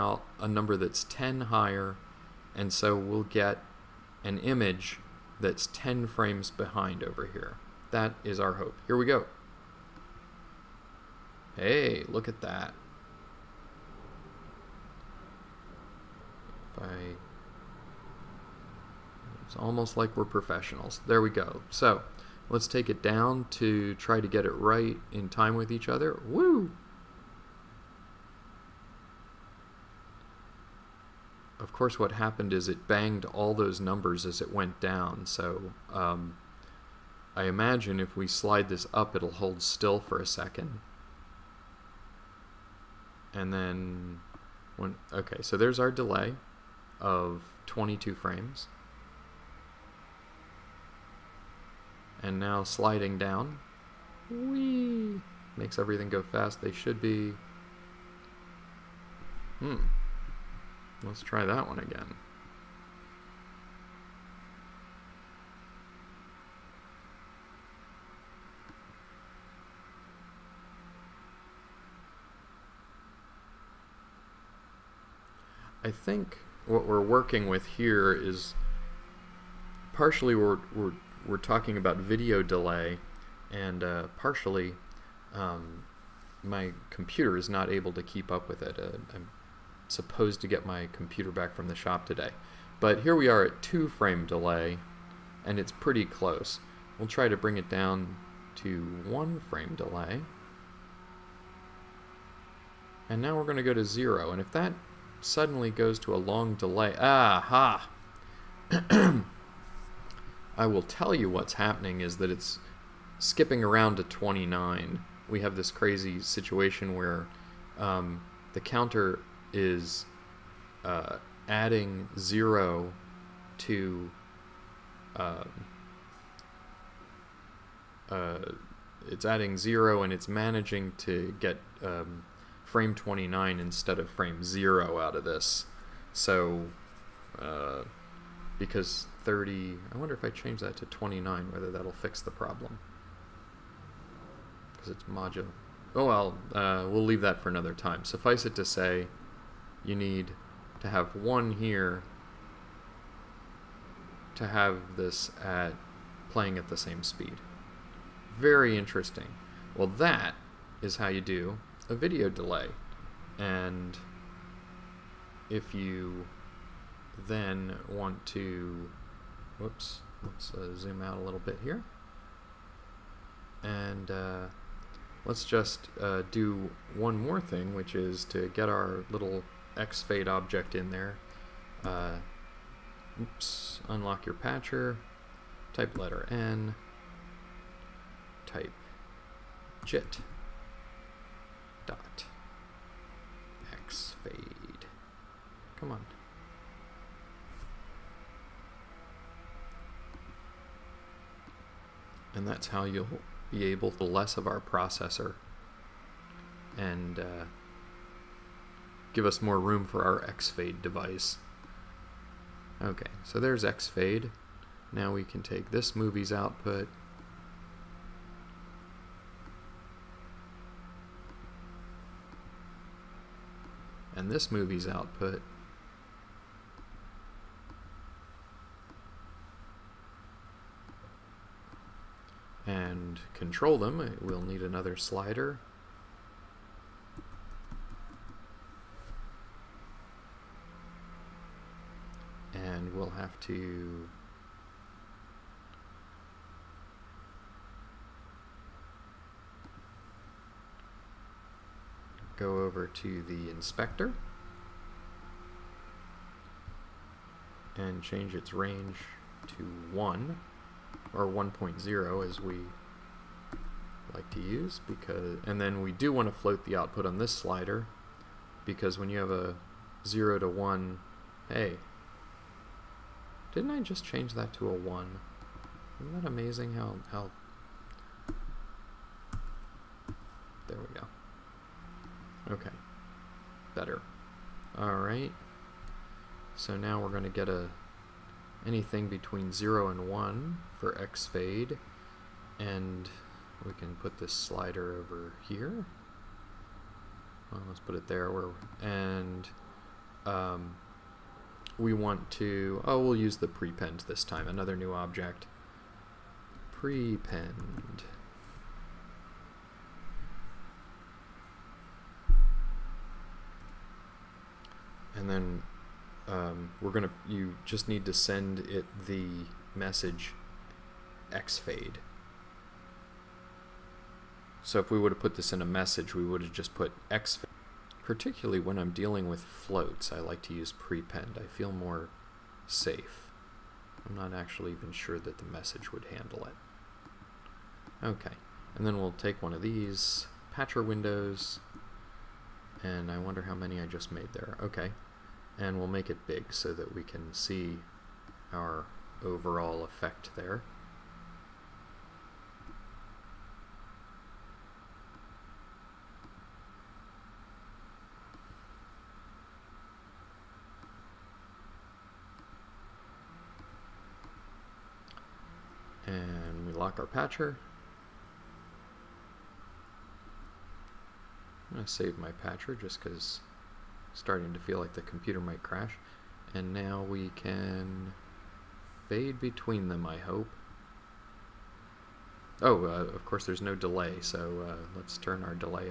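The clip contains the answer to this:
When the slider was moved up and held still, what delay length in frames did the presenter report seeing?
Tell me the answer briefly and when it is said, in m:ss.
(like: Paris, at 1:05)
22 frames, at 0:47.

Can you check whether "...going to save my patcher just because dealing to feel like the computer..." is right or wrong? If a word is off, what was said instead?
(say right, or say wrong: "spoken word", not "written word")
wrong: "starting", not "dealing".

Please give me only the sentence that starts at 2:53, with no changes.
And uh, let's just uh, do one more thing, which is to get our little X-Fade object in there.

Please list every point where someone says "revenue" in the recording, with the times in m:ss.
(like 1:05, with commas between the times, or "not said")
not said.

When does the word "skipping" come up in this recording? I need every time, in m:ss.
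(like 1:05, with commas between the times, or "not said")
1:53.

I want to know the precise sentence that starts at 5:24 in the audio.
So if we would have put this in a message, we would have just put xfade.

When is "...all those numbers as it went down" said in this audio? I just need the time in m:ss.
0:33.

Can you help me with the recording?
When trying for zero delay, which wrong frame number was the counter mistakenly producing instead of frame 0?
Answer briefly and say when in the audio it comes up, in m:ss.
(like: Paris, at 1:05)
29, at 2:12.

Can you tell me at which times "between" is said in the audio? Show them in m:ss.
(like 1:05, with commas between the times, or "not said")
4:49, 6:19.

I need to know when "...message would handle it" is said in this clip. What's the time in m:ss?
5:35.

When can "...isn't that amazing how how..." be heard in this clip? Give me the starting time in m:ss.
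4:35.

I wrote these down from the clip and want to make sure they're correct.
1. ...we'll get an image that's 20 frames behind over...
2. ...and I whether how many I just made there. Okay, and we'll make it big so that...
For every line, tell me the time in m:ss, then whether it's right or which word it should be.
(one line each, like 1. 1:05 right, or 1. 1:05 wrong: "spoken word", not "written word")
1. 0:02 wrong: "10", not "20"
2. 5:42 wrong: "wonder", not "whether".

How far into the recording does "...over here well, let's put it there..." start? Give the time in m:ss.
4:54.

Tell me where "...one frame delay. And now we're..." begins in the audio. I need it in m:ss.
1:39.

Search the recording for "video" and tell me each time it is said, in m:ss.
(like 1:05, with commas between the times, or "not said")
1:21, 2:41.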